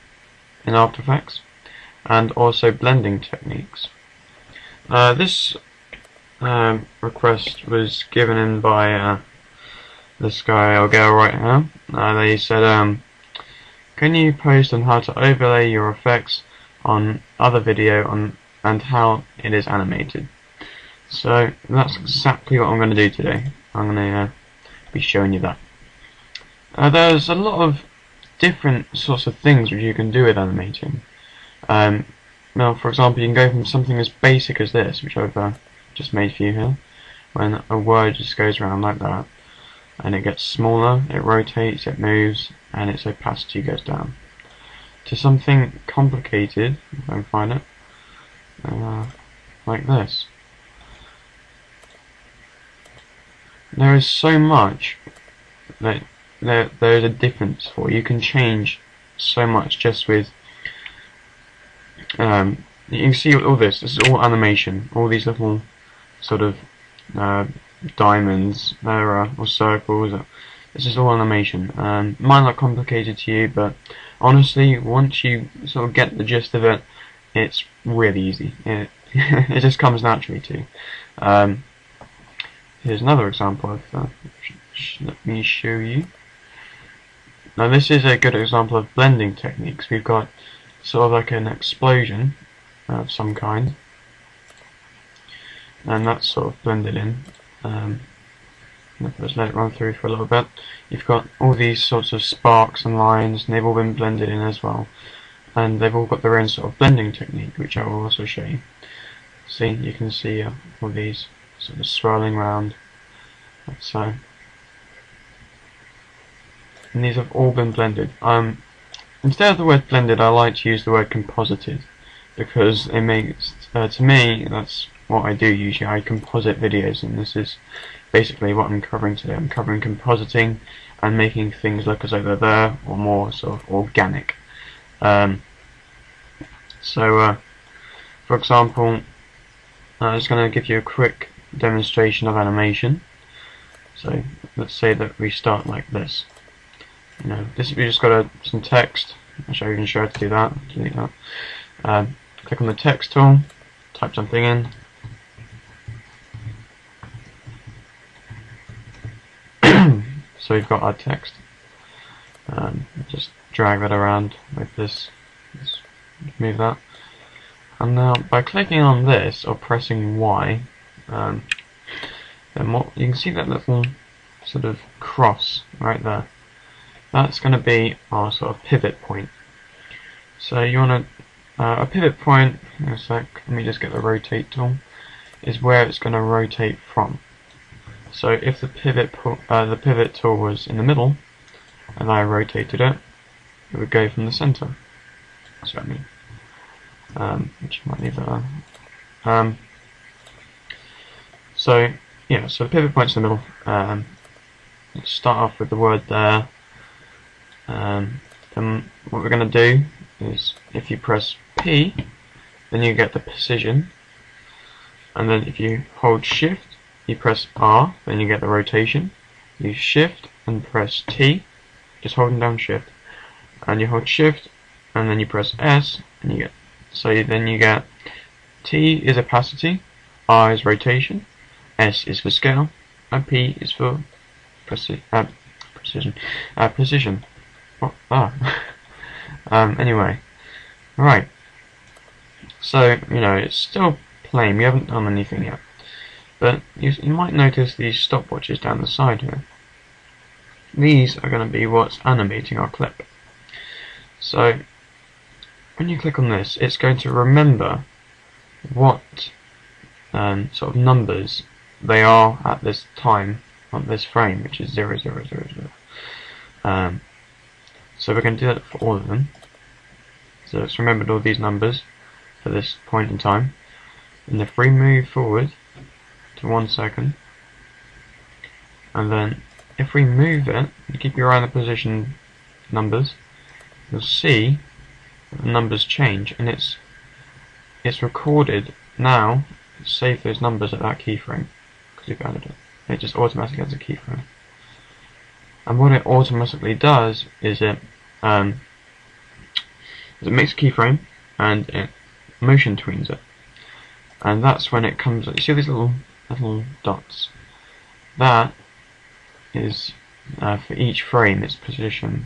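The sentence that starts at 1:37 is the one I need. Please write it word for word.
Um, let's let it run through for a little bit.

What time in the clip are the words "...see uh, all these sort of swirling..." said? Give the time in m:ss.
1:50.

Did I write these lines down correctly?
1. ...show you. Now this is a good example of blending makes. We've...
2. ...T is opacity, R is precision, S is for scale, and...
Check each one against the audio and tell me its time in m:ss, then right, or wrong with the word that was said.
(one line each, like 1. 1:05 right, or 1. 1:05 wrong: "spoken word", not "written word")
1. 1:25 wrong: "techniques", not "makes"
2. 3:48 wrong: "rotation", not "precision".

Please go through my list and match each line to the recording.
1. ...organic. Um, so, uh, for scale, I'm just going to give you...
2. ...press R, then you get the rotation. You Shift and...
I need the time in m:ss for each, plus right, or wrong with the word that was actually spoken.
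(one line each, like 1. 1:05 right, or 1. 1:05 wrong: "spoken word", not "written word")
1. 2:13 wrong: "example", not "scale"
2. 3:37 right.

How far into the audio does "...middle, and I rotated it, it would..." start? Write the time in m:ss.
3:10.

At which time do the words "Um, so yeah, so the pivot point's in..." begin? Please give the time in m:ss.
3:19.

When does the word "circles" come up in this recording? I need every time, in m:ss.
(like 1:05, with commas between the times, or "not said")
1:09.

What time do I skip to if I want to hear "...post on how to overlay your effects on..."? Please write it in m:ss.
0:14.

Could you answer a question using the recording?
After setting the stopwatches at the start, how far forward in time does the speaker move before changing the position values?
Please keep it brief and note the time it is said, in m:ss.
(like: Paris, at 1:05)
1 second, at 4:36.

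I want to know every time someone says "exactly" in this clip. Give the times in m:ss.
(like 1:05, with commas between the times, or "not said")
0:21.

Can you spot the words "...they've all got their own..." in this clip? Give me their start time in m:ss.
1:45.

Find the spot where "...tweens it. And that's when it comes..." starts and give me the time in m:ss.
5:02.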